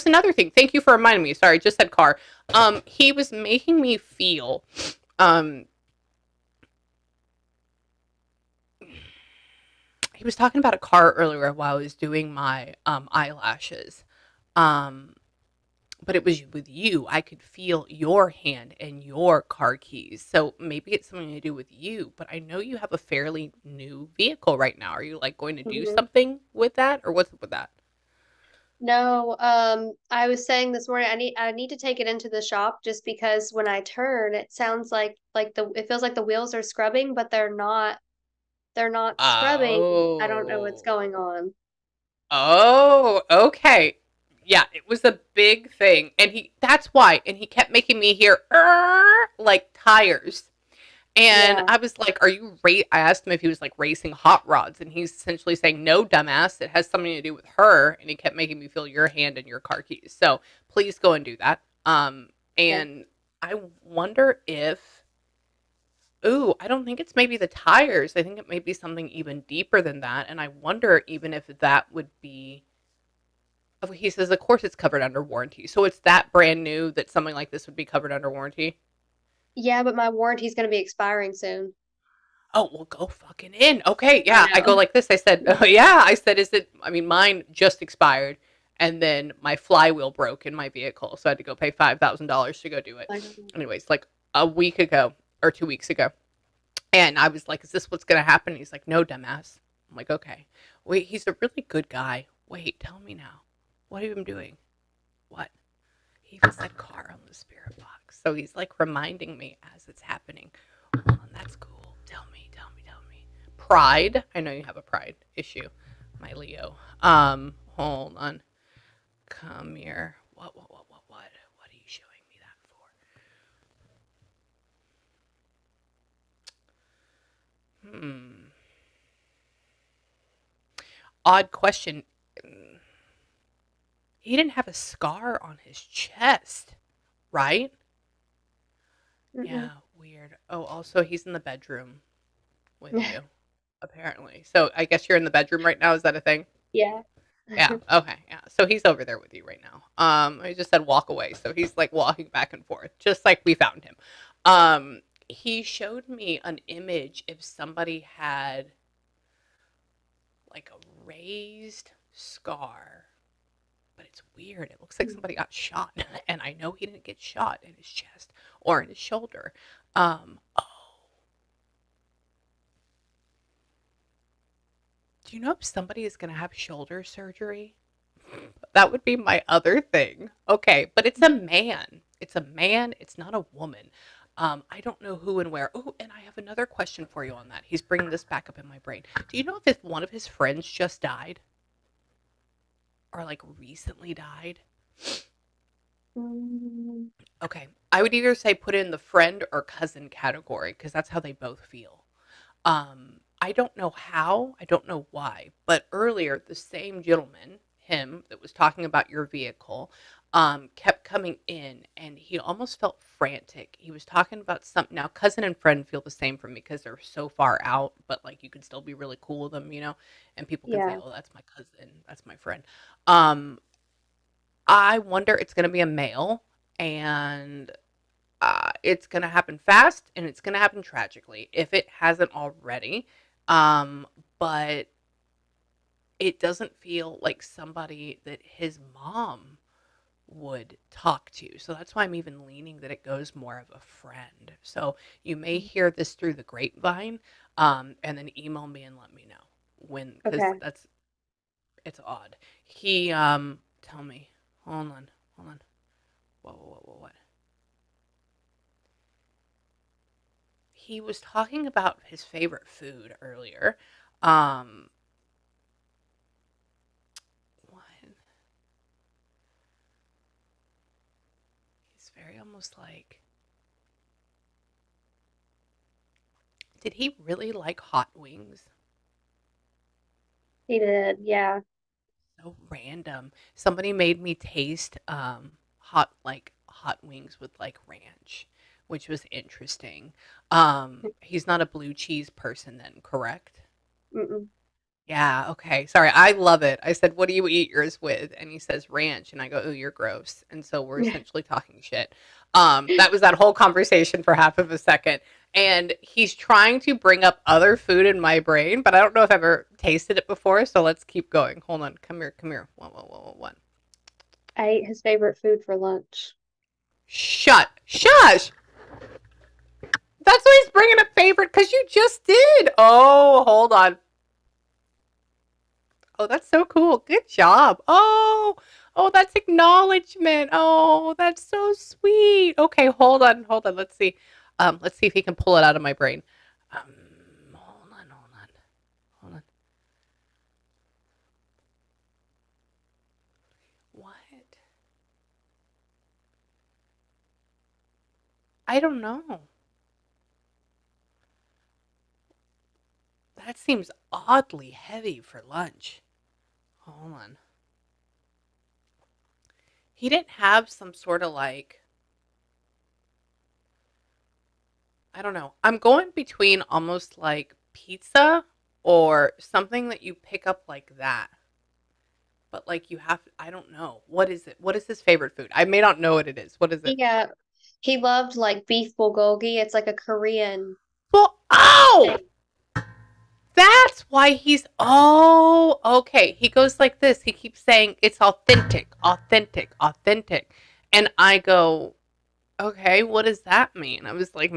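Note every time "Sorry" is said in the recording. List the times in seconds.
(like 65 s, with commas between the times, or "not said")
1 s, 295 s.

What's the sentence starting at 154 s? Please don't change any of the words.
Um, he showed me an image if somebody had like a raised scar but it's weird.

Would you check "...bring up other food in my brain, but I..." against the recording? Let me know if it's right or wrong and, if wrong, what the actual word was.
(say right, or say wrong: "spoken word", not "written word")
right.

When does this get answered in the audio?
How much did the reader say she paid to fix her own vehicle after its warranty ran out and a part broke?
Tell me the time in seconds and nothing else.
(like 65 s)
91 s.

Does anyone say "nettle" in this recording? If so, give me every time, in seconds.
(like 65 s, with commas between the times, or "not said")
not said.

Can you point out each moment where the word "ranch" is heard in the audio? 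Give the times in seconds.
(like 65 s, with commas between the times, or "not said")
287 s, 298 s.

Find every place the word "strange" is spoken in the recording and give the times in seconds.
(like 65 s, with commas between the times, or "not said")
not said.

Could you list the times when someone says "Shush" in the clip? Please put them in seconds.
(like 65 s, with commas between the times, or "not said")
317 s.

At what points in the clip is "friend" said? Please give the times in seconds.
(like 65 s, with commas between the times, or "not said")
190 s, 198 s, 215 s, 222 s, 243 s.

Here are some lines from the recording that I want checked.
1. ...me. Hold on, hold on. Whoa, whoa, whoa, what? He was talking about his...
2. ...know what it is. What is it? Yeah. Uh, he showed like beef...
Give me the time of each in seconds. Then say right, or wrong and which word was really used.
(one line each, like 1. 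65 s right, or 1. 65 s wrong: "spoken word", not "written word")
1. 254 s right
2. 375 s wrong: "loved", not "showed".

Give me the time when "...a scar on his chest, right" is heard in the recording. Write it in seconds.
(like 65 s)
134 s.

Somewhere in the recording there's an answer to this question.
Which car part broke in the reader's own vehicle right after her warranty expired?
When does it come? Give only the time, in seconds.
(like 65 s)
89 s.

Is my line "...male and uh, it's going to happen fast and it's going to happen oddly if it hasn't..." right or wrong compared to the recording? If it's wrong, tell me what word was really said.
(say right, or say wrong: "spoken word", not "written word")
wrong: "tragically", not "oddly".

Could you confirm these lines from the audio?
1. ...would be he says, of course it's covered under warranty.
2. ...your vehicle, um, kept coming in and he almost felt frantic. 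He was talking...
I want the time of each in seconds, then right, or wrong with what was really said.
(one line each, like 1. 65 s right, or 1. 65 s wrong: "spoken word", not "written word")
1. 71 s right
2. 209 s right.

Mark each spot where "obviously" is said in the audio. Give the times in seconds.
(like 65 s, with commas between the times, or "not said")
not said.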